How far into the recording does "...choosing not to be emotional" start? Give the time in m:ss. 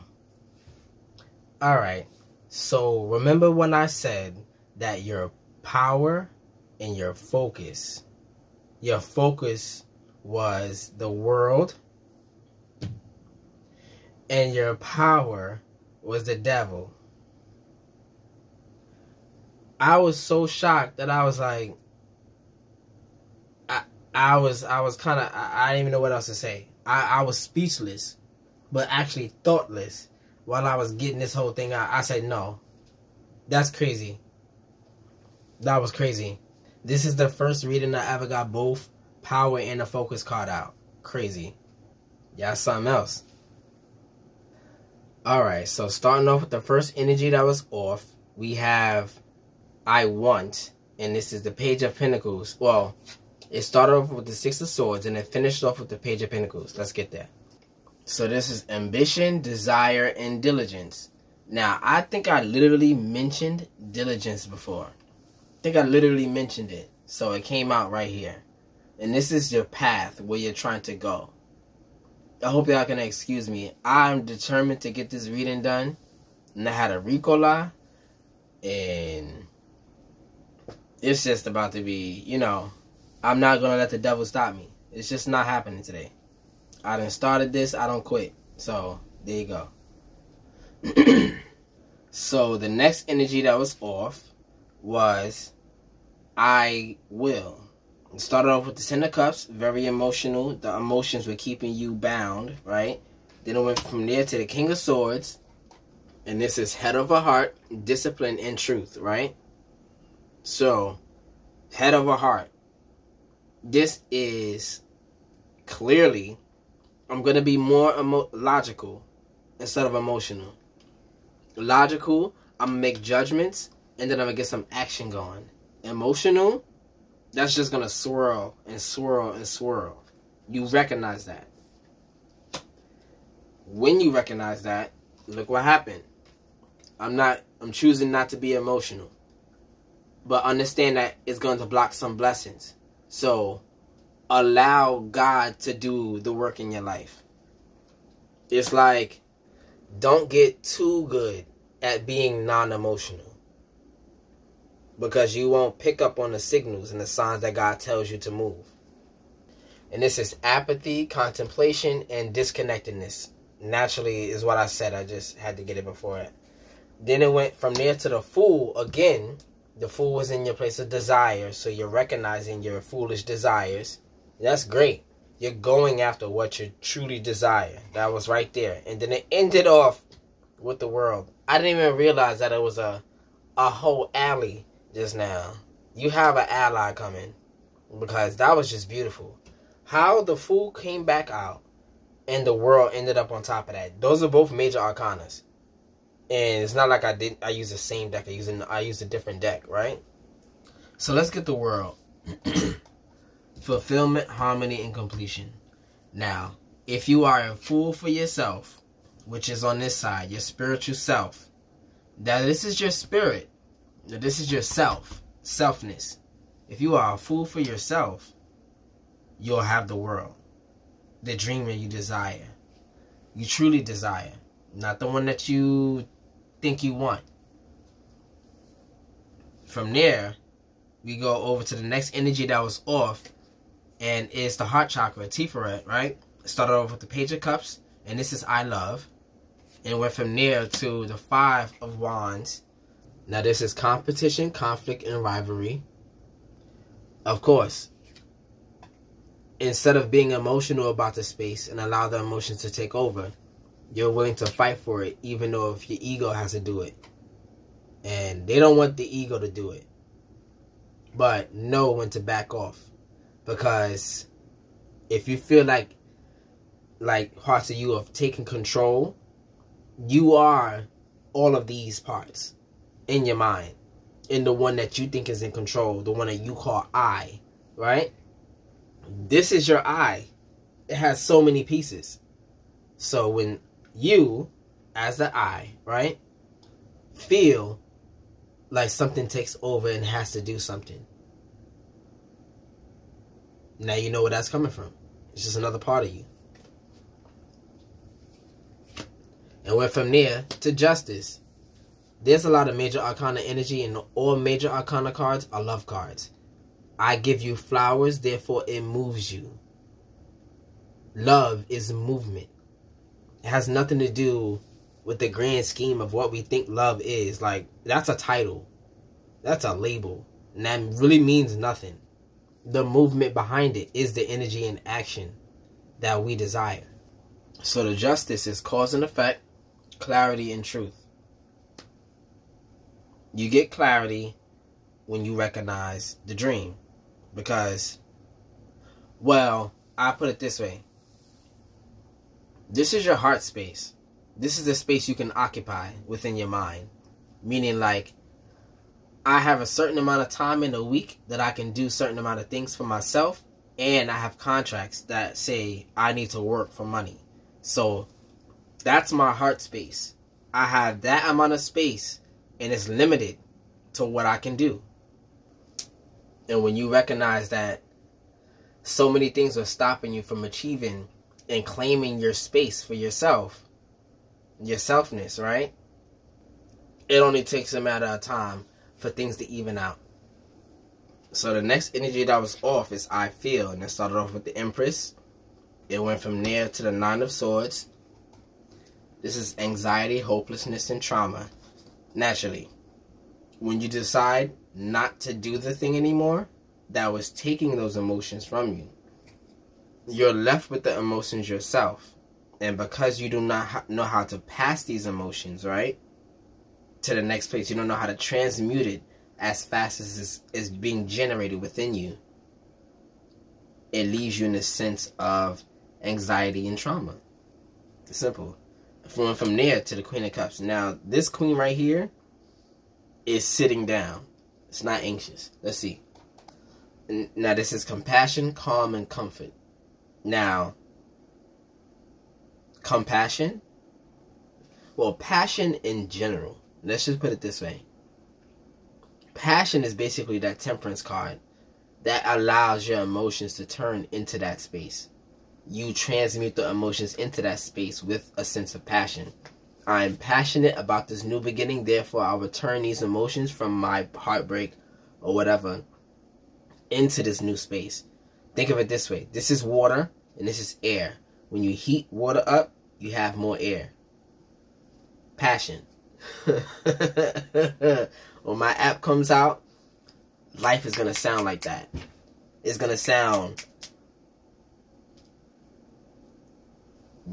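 2:17.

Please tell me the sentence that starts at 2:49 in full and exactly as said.
The fool was in your place of desire, so you're recognizing your foolish desires.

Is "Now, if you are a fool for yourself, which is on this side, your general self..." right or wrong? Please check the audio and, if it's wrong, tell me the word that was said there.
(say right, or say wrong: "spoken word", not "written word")
wrong: "spiritual", not "general".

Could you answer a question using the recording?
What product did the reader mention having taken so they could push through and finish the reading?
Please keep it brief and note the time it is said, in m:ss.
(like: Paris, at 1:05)
Ricola, at 1:17.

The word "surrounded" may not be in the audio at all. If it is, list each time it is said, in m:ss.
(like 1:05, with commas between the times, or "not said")
not said.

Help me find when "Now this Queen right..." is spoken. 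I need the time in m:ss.
7:00.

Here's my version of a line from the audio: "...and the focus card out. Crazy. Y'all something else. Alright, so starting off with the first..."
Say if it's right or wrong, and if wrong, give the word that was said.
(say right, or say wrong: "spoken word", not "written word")
right.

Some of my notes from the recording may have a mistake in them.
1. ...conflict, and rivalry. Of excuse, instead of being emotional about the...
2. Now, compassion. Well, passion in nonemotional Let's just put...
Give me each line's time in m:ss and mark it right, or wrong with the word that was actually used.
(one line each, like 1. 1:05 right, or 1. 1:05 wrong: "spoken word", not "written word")
1. 4:04 wrong: "course", not "excuse"
2. 7:10 wrong: "general", not "nonemotional".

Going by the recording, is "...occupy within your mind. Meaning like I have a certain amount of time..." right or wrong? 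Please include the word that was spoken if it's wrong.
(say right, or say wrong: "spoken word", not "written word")
right.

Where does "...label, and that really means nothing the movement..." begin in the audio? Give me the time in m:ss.
5:19.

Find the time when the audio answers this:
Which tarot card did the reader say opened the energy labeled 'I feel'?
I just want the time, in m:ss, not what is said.
6:24.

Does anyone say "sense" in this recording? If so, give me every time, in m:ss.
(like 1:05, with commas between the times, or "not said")
6:54, 7:28.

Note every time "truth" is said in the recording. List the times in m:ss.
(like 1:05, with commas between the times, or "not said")
1:48, 5:30.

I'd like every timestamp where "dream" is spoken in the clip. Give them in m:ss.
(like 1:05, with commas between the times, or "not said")
3:41, 5:36.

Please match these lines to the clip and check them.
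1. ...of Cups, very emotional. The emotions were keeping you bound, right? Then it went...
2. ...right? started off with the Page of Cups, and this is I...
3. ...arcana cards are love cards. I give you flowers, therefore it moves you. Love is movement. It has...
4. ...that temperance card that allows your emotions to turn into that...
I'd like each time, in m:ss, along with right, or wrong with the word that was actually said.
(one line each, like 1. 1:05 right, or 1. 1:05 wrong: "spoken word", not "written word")
1. 1:39 right
2. 3:55 right
3. 5:04 right
4. 7:20 right.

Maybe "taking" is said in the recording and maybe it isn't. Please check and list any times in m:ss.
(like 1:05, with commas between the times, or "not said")
4:28, 6:37.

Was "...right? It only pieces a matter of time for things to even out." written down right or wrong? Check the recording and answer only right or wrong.
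wrong.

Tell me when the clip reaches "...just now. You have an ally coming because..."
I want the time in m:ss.
3:04.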